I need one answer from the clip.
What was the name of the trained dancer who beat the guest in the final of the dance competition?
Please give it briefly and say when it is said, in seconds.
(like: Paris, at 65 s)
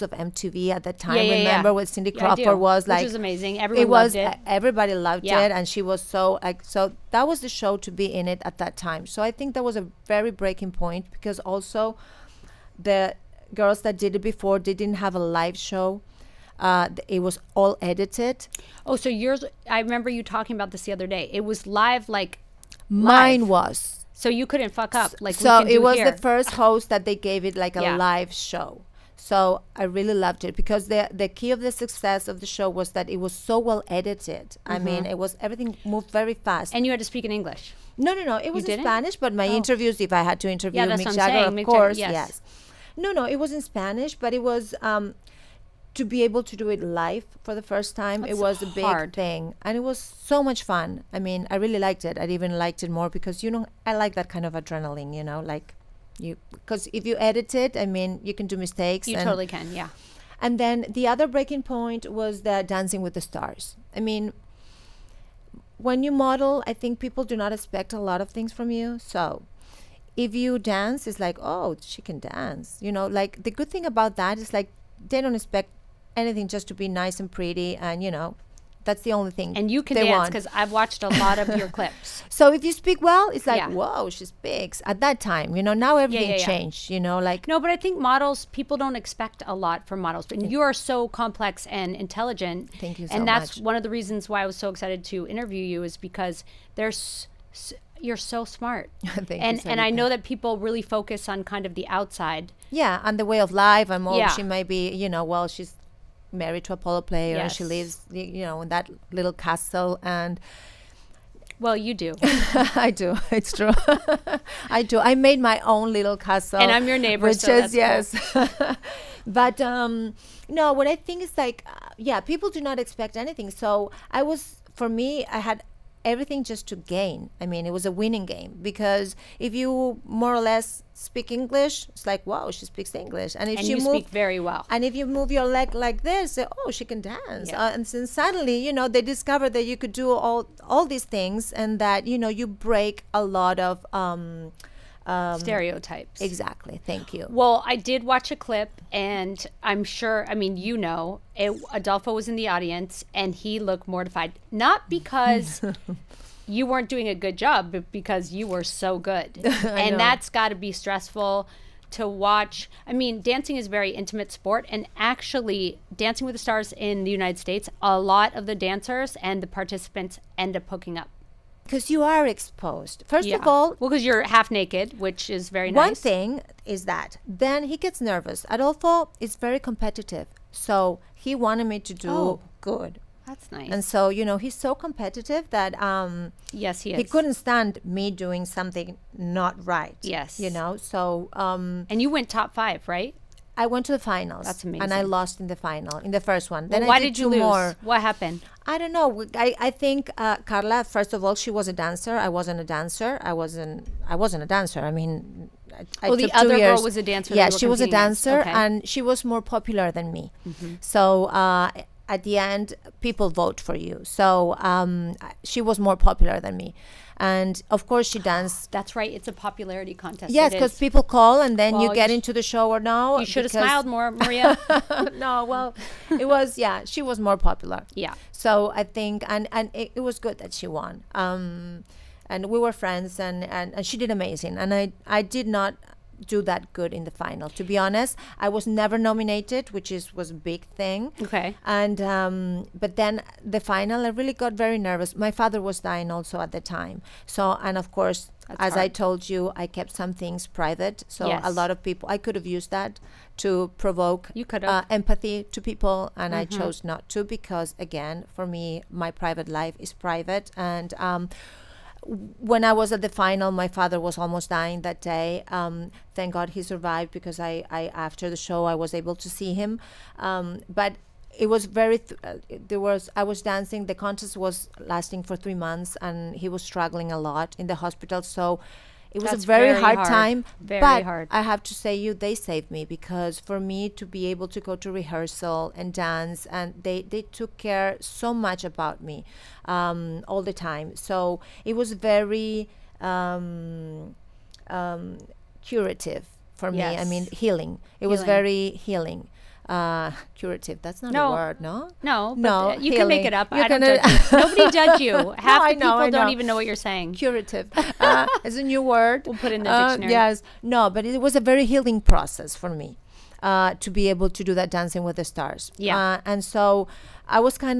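Carla, at 200 s.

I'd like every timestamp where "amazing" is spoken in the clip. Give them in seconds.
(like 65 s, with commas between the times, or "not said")
3 s, 194 s, 234 s.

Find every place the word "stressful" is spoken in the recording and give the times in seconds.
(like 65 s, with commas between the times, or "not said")
160 s.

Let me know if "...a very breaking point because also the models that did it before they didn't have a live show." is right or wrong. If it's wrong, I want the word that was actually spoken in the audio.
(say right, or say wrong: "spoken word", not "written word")
wrong: "girls", not "models".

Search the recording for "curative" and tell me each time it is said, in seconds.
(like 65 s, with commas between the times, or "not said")
295 s, 300 s, 307 s.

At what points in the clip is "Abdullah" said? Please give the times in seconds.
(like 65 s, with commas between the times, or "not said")
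not said.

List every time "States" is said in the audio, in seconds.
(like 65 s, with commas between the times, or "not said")
167 s.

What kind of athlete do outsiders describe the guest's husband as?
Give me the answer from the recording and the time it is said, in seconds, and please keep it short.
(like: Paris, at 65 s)
Polo player, at 106 s.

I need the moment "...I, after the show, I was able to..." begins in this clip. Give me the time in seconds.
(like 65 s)
267 s.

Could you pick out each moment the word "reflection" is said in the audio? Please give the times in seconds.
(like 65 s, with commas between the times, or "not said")
not said.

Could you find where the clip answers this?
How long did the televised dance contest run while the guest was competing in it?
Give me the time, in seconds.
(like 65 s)
275 s.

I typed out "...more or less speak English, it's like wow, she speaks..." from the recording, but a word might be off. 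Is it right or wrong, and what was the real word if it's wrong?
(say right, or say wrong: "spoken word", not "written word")
right.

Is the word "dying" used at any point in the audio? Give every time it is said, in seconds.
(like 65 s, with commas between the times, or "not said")
245 s, 264 s.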